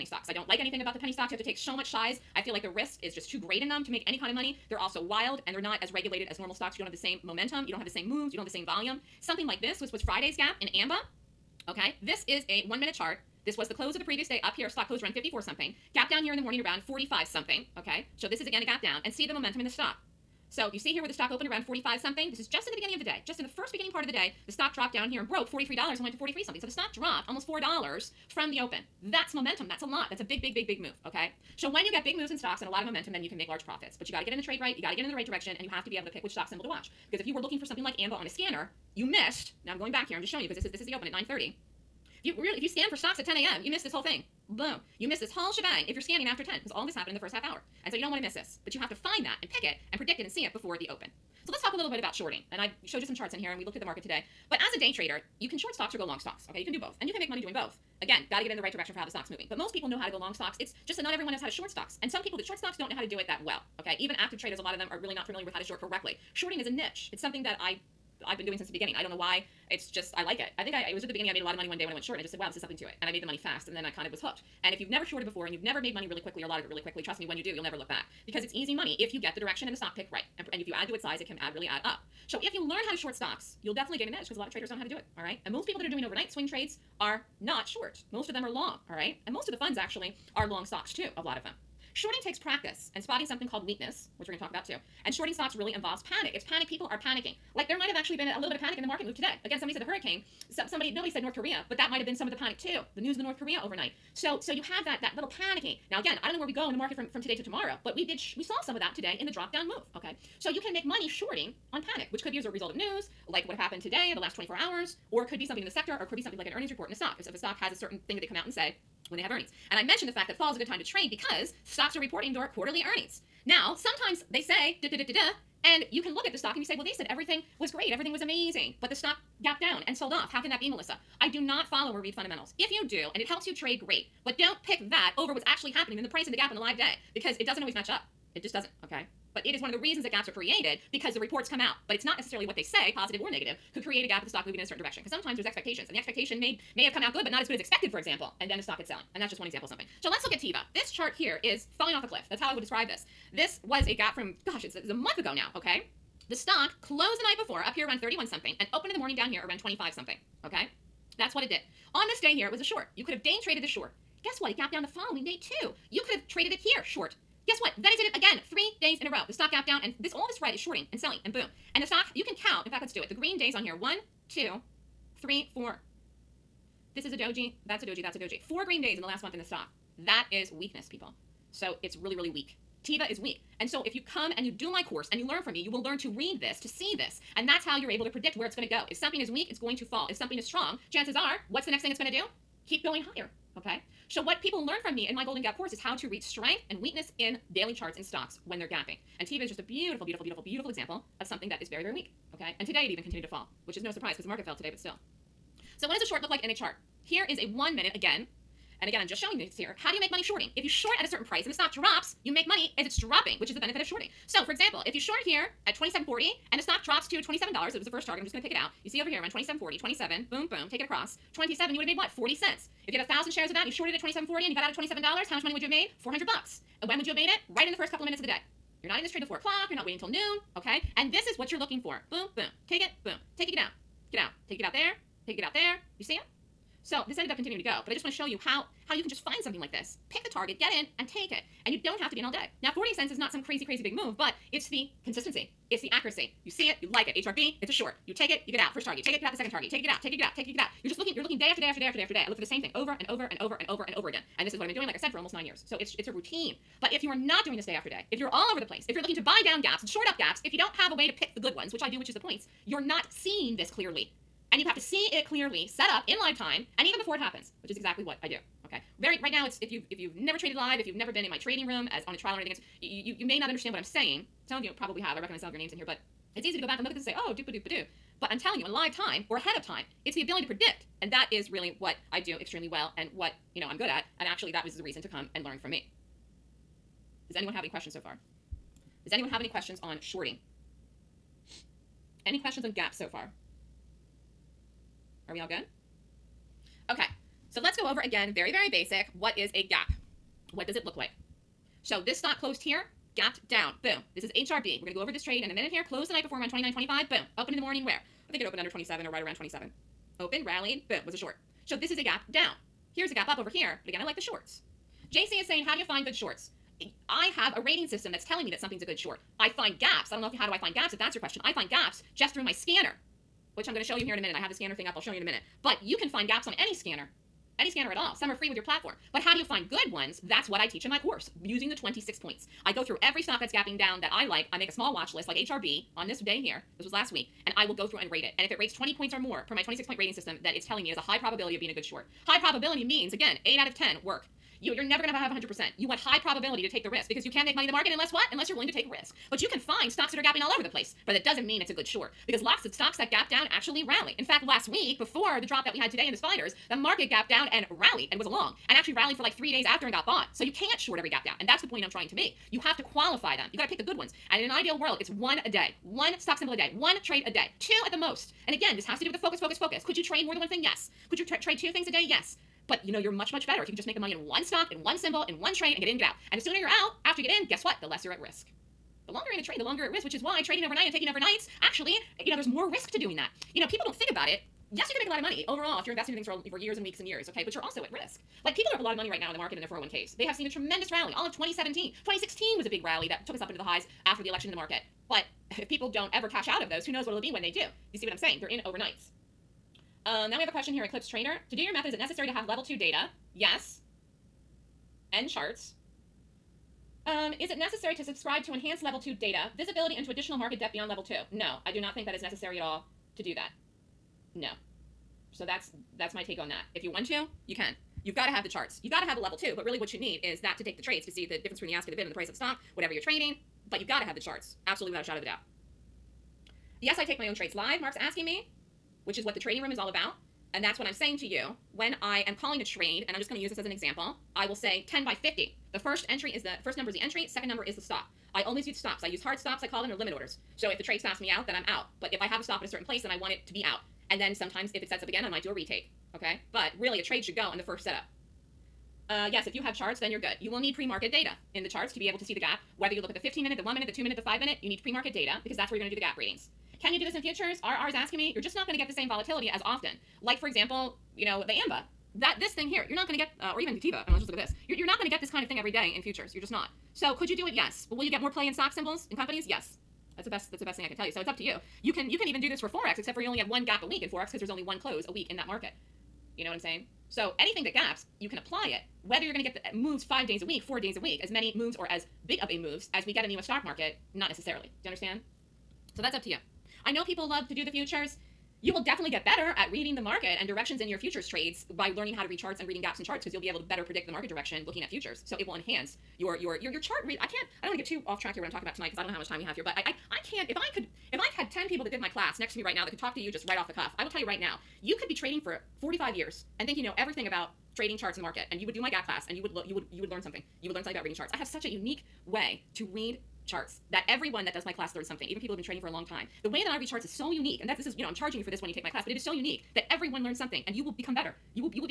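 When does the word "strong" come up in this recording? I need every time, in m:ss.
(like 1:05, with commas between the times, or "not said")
3:10.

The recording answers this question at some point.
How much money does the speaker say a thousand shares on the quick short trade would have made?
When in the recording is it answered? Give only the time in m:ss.
3:45.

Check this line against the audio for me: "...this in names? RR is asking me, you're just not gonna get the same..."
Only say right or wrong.
wrong.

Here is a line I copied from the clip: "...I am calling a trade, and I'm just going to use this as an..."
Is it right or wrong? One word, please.
right.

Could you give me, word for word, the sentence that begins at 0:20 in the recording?
So you see here where the stock opened around 45 something.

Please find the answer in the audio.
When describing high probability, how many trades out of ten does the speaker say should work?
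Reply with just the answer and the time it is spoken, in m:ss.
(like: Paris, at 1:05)
8 out of 10, at 5:43.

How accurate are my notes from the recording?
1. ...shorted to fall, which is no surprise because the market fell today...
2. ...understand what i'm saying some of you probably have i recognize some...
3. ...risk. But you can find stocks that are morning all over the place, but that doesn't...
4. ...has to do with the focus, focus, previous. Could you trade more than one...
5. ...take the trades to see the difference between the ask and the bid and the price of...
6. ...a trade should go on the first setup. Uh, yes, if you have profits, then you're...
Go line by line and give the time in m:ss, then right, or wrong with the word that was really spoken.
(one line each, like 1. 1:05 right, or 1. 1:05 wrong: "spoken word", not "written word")
1. 3:23 wrong: "continued", not "shorted"
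2. 4:33 right
3. 5:48 wrong: "gapping", not "morning"
4. 6:08 wrong: "focus", not "previous"
5. 7:00 right
6. 7:26 wrong: "charts", not "profits".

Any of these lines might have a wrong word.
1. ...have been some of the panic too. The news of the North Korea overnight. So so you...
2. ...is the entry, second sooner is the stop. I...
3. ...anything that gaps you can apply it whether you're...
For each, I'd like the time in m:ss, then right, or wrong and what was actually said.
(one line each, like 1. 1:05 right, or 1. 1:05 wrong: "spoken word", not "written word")
1. 1:41 right
2. 7:16 wrong: "number", not "sooner"
3. 7:57 right.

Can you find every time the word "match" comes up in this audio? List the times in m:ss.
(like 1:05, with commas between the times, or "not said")
2:17.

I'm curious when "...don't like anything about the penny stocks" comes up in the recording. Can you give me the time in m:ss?
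0:00.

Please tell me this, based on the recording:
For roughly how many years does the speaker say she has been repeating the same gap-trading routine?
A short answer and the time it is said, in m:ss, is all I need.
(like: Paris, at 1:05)
almost 9 years, at 4:15.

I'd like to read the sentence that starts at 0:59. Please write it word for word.
But most people know how to go long stocks.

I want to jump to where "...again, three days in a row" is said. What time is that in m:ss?
2:48.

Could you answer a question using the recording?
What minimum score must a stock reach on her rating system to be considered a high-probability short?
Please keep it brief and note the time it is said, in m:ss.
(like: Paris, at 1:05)
20 points, at 5:38.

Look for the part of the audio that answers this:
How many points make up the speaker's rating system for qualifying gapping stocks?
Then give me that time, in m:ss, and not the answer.
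5:39.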